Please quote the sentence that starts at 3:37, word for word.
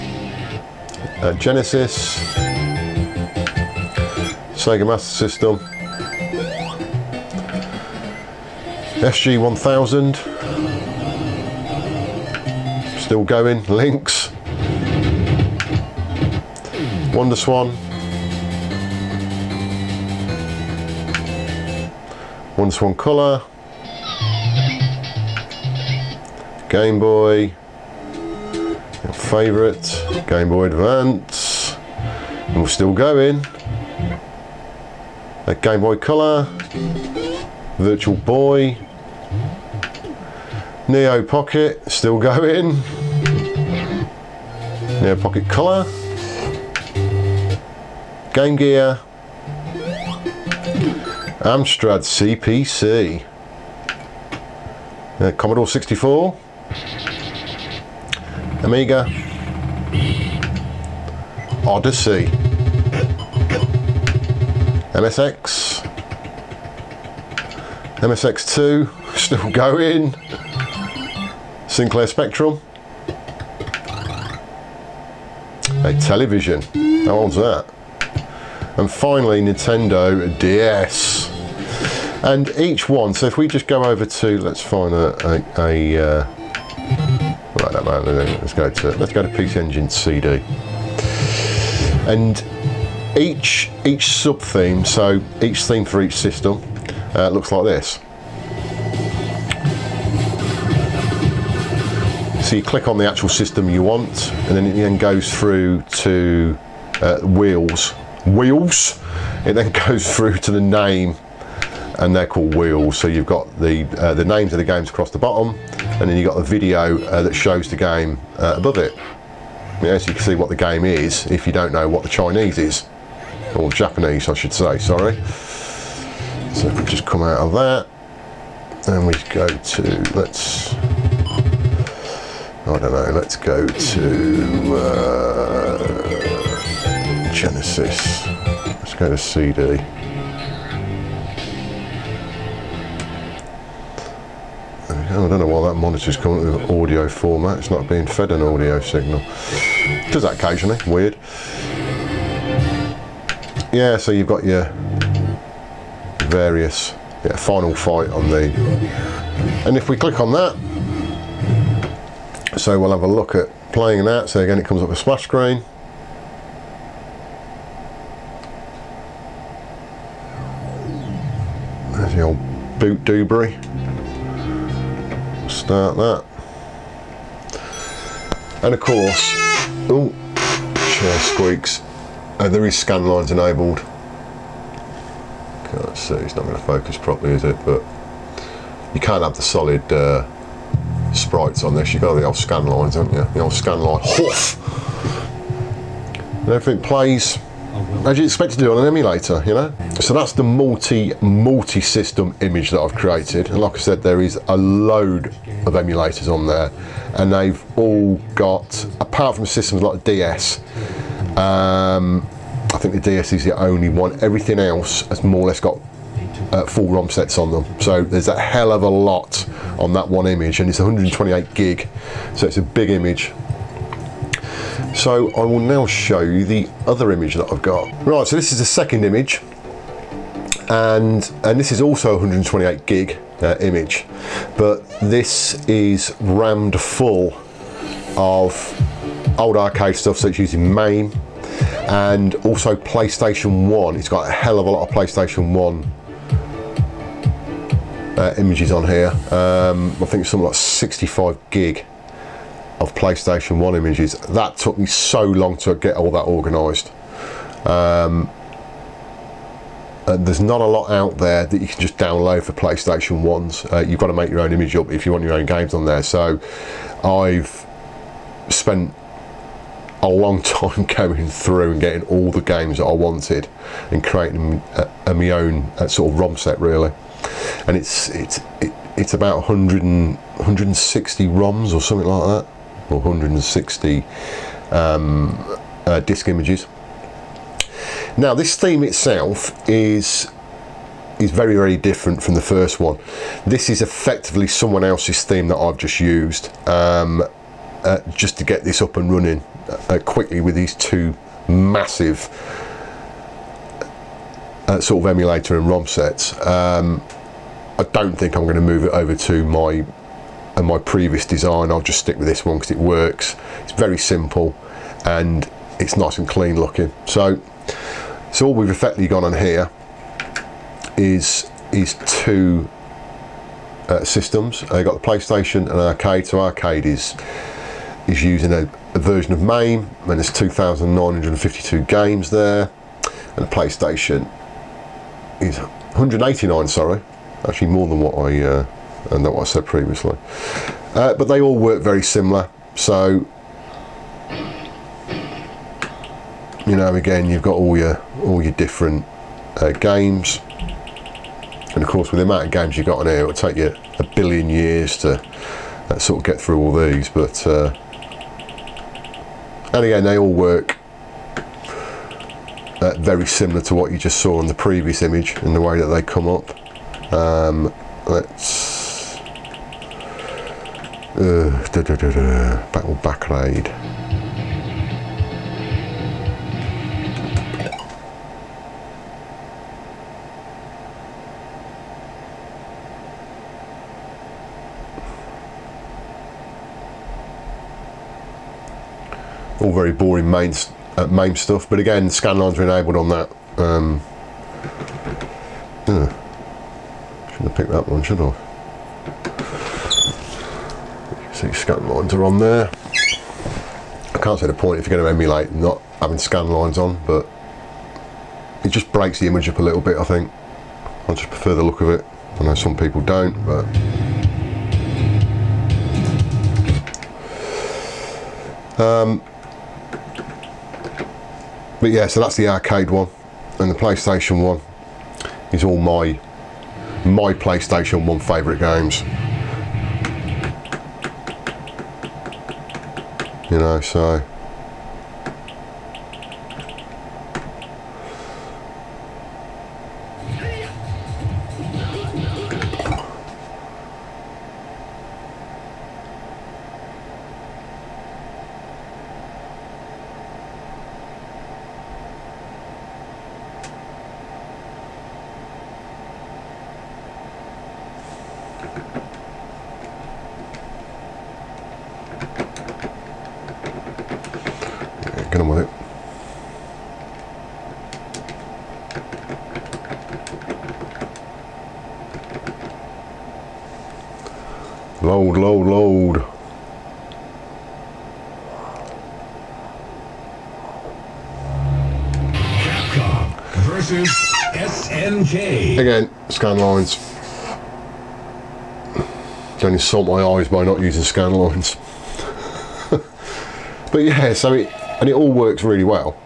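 So there's a hell of a lot on that one image and it's 128 gig.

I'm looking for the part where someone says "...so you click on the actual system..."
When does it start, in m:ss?
1:42.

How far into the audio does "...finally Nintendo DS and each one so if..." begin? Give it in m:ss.
1:18.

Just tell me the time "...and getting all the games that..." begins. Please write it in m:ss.
4:31.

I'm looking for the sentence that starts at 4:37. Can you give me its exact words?
And it's, it's, it, it's about 100 and, 160 ROMs or something like that or 160 um, uh, disk images.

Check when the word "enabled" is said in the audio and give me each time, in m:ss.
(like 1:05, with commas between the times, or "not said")
3:03, 6:32.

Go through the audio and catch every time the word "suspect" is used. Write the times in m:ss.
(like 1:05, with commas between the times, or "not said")
not said.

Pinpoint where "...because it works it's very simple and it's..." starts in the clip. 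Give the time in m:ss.
5:12.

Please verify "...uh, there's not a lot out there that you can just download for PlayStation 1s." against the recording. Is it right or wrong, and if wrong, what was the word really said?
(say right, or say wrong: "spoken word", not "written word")
right.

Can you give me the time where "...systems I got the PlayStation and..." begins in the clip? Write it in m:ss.
5:24.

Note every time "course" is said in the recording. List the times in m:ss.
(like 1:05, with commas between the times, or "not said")
2:58, 5:51.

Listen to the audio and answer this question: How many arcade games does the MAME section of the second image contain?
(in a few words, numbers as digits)
2,952.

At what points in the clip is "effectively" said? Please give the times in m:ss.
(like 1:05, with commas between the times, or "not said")
4:53, 5:18.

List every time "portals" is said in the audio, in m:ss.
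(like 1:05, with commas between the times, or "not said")
not said.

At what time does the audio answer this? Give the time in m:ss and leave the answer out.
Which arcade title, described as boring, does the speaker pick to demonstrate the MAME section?
6:12.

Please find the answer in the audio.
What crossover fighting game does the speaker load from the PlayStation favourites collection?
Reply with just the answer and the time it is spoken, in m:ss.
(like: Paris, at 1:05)
Capcom versus SNK, at 8:02.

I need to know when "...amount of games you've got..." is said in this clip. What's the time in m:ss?
5:52.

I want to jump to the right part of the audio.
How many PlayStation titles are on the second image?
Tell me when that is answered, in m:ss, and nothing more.
5:35.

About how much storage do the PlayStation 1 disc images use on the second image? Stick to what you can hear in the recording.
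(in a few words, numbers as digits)
65 gig.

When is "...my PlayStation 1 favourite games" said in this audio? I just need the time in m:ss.
7:07.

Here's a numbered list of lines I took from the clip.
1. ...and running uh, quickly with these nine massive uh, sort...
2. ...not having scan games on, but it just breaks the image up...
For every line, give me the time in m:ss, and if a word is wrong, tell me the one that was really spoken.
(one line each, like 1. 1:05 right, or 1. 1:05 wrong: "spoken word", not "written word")
1. 4:58 wrong: "two", not "nine"
2. 6:45 wrong: "lines", not "games".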